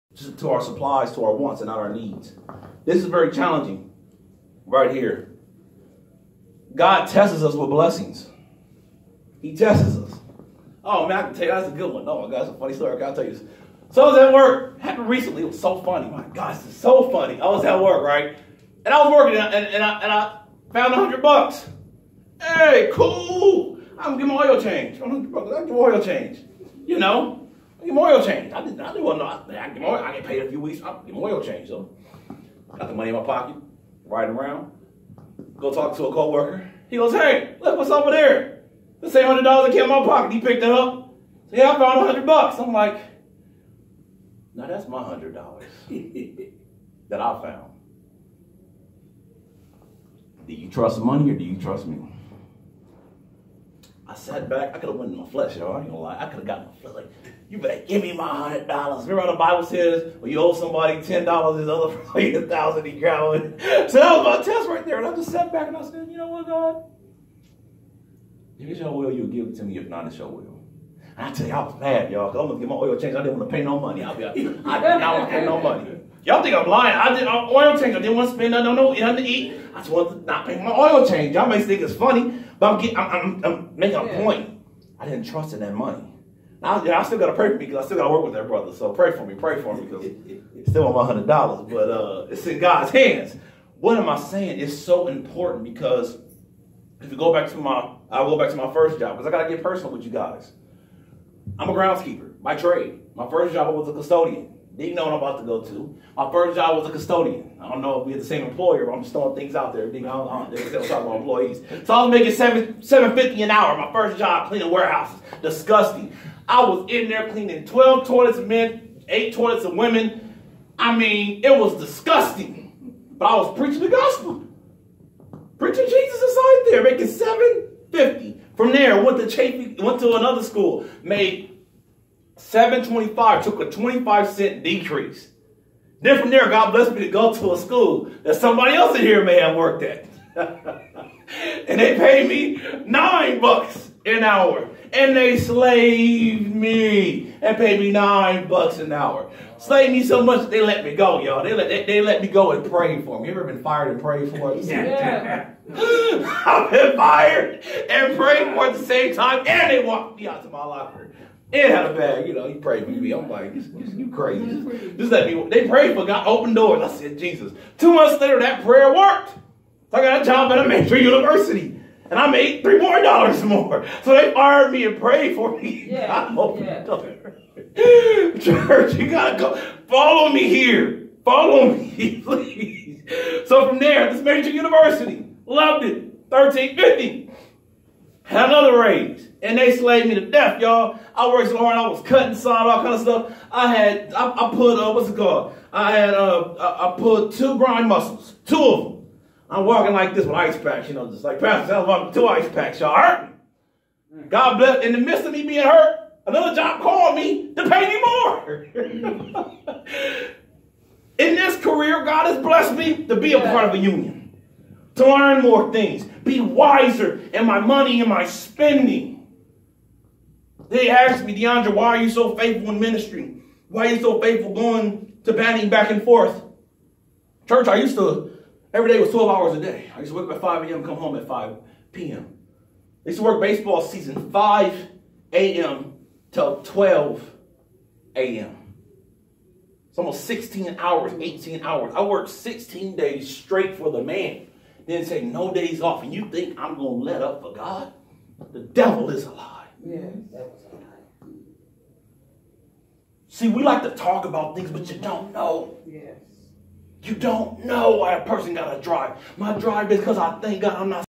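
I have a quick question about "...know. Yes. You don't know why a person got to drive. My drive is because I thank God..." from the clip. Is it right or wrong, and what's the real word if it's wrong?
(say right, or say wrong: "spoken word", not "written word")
right.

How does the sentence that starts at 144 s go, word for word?
And they slaved me and paid me nine bucks an hour.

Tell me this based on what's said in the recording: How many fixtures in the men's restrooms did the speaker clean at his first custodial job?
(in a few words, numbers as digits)
12.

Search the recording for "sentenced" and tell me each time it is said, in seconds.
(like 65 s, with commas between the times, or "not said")
not said.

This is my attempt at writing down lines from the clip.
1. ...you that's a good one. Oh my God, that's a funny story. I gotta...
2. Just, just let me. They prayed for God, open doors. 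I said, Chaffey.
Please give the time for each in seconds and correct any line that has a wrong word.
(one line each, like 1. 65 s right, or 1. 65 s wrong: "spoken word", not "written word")
1. 11 s right
2. 164 s wrong: "Jesus", not "Chaffey".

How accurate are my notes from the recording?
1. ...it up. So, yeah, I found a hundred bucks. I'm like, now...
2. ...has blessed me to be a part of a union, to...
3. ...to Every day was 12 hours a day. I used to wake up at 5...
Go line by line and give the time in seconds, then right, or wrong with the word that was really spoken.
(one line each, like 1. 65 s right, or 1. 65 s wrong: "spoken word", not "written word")
1. 40 s right
2. 212 s right
3. 227 s right.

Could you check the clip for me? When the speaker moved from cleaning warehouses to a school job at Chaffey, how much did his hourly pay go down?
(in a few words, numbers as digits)
25 cents.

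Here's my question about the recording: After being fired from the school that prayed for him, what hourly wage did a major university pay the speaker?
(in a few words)
$13.50.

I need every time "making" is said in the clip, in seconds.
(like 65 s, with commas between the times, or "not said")
83 s, 112 s, 126 s.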